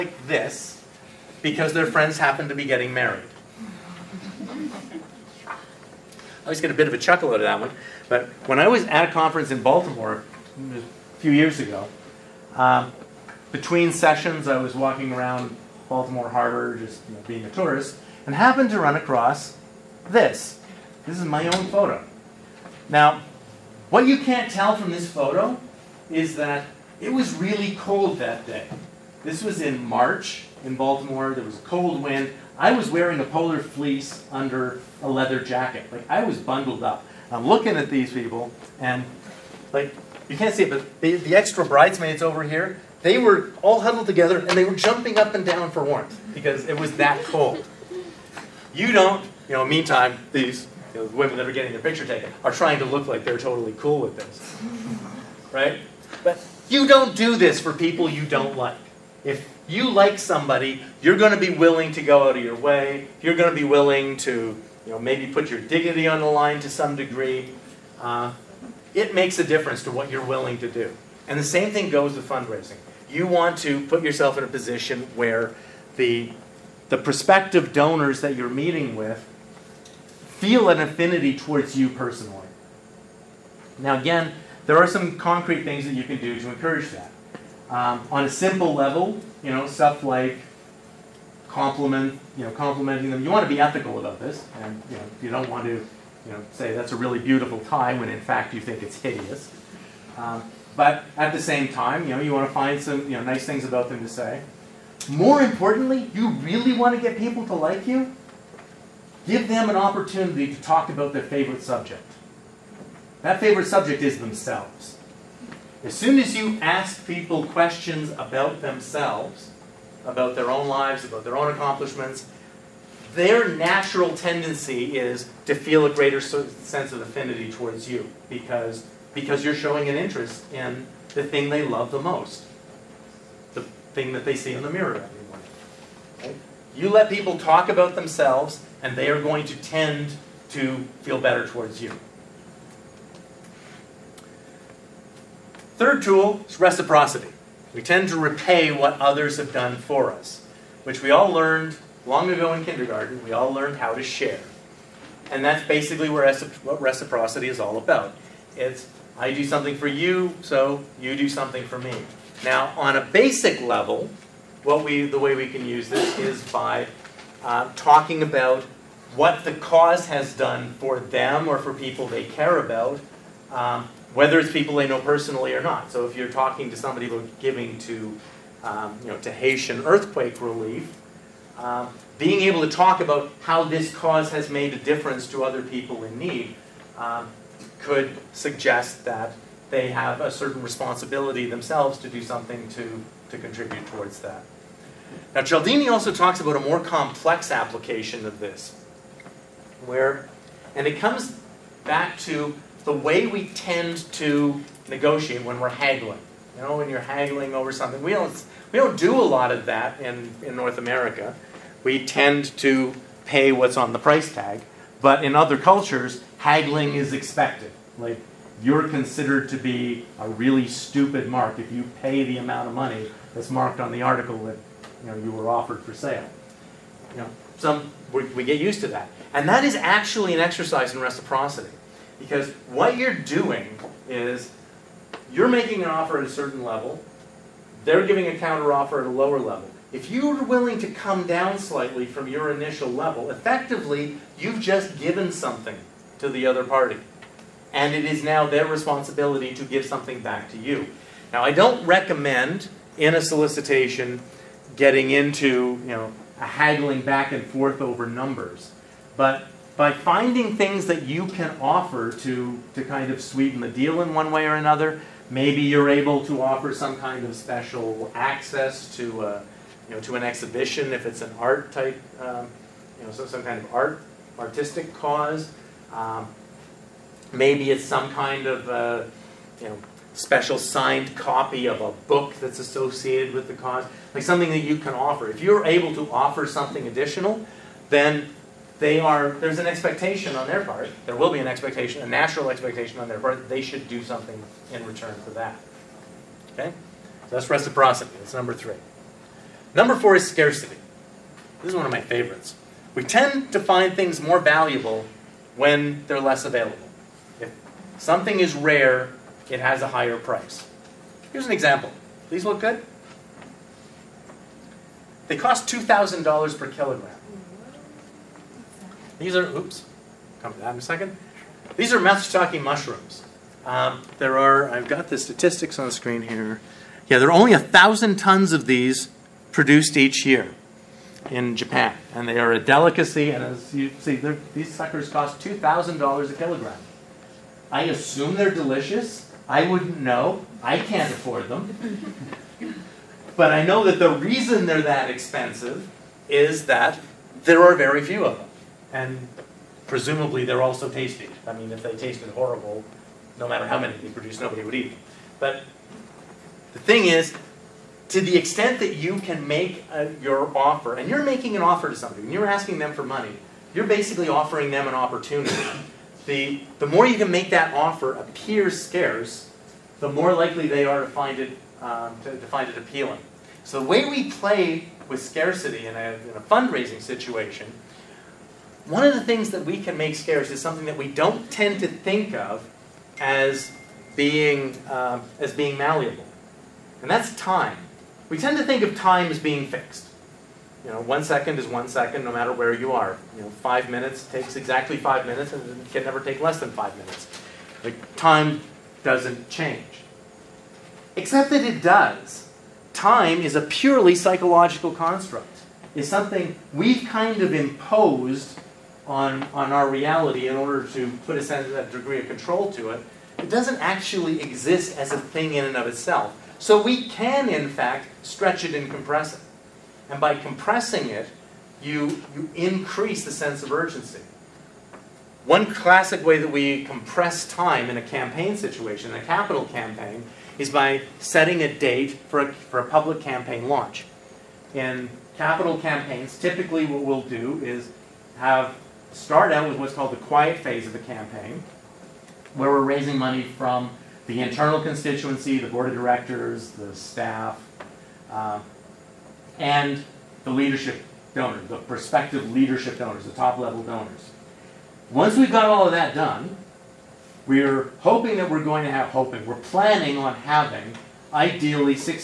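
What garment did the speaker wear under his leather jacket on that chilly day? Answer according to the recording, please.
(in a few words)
Polar fleece.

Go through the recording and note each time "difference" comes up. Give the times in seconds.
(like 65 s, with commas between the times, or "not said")
69 s, 184 s.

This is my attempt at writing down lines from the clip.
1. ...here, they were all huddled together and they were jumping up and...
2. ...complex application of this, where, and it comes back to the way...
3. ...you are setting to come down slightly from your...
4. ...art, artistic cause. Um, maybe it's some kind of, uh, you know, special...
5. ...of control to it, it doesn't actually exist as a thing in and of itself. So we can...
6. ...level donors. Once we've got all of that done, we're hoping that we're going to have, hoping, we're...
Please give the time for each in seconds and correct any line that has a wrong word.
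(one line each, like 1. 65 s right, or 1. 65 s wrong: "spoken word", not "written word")
1. 42 s right
2. 196 s right
3. 240 s wrong: "willing", not "setting"
4. 273 s right
5. 412 s right
6. 453 s right.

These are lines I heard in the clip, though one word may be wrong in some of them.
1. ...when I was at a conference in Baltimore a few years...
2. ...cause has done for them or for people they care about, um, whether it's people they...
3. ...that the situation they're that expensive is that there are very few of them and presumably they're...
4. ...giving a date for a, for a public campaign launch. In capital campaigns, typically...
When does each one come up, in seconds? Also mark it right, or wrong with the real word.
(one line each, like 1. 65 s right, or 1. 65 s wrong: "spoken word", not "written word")
1. 8 s right
2. 169 s right
3. 343 s wrong: "reason", not "situation"
4. 431 s wrong: "setting", not "giving".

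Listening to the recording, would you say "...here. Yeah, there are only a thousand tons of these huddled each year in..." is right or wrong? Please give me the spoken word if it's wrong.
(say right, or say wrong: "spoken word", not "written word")
wrong: "produced", not "huddled".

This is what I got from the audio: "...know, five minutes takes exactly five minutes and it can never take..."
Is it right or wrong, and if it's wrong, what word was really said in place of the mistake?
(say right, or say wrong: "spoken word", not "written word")
right.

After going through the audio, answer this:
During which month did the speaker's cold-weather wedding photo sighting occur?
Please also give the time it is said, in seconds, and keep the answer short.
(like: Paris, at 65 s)
March, at 29 s.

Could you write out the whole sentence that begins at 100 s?
Um, but at the same time, you know, you want to find some, you know, nice things about them to say.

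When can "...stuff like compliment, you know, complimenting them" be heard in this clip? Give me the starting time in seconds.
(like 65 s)
89 s.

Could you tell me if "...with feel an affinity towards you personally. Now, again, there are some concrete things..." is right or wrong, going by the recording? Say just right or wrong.
right.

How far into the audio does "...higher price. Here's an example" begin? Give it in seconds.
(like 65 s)
309 s.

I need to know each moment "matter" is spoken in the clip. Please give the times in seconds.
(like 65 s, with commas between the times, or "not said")
353 s, 392 s.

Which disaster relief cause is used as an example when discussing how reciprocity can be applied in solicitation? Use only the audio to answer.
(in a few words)
Haitian earthquake relief.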